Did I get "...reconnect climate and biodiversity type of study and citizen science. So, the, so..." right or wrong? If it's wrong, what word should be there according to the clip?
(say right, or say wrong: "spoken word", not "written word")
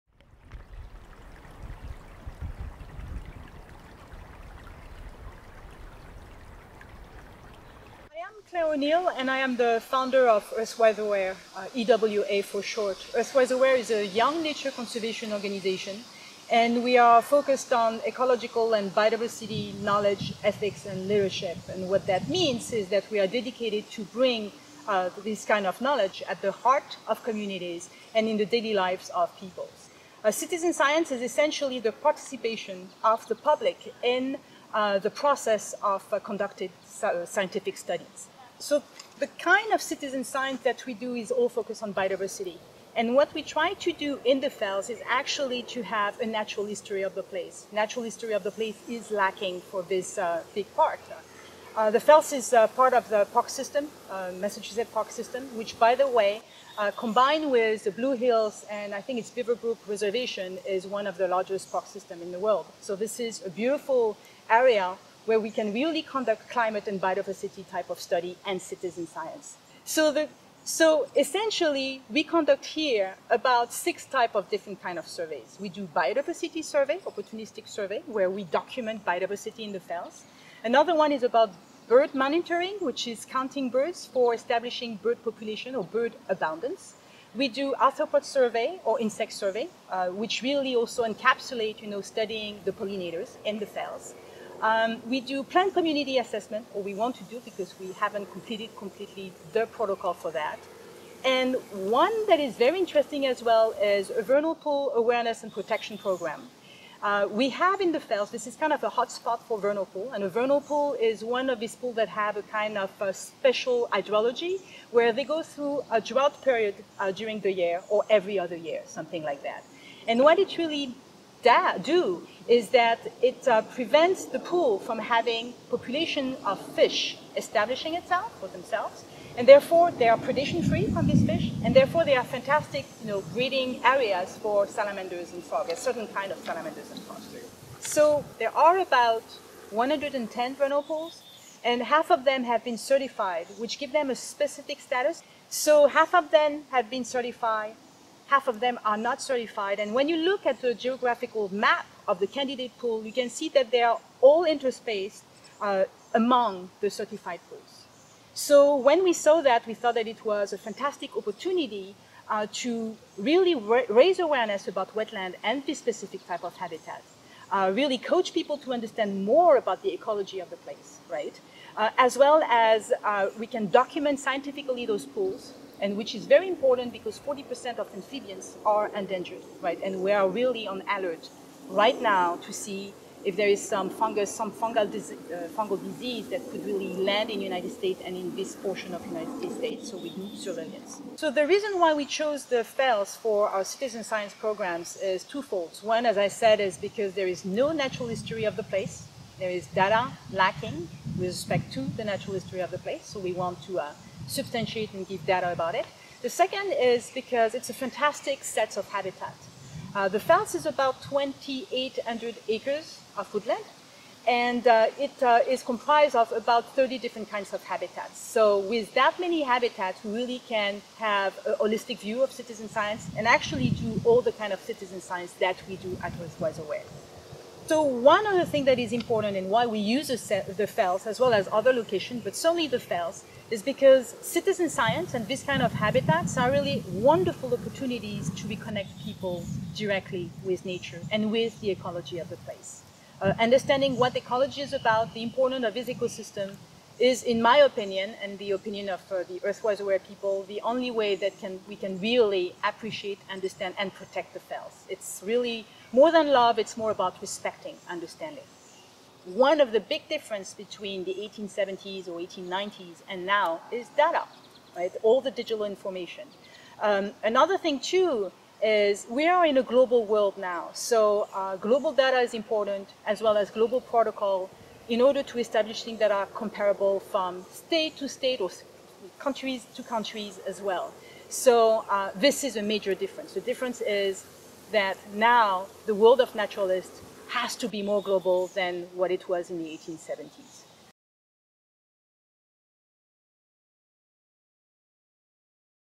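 wrong: "conduct", not "reconnect".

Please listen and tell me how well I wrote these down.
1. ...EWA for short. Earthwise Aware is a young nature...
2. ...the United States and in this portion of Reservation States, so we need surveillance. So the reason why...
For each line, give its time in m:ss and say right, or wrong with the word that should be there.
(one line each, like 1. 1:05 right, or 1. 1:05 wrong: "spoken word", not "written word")
1. 0:11 right
2. 3:07 wrong: "United", not "Reservation".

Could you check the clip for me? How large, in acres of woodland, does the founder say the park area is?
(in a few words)
2,800 acres.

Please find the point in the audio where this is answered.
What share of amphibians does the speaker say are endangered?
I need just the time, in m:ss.
2:57.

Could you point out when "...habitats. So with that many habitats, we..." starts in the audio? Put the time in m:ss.
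3:37.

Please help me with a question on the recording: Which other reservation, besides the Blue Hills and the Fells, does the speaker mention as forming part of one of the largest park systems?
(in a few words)
Beaverbrook Reservation.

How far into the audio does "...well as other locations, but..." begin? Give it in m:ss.
3:51.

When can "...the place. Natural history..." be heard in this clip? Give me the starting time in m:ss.
0:47.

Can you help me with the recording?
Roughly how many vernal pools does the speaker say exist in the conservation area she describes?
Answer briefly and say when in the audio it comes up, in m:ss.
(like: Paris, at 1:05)
110, at 2:19.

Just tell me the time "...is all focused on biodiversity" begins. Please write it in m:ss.
0:41.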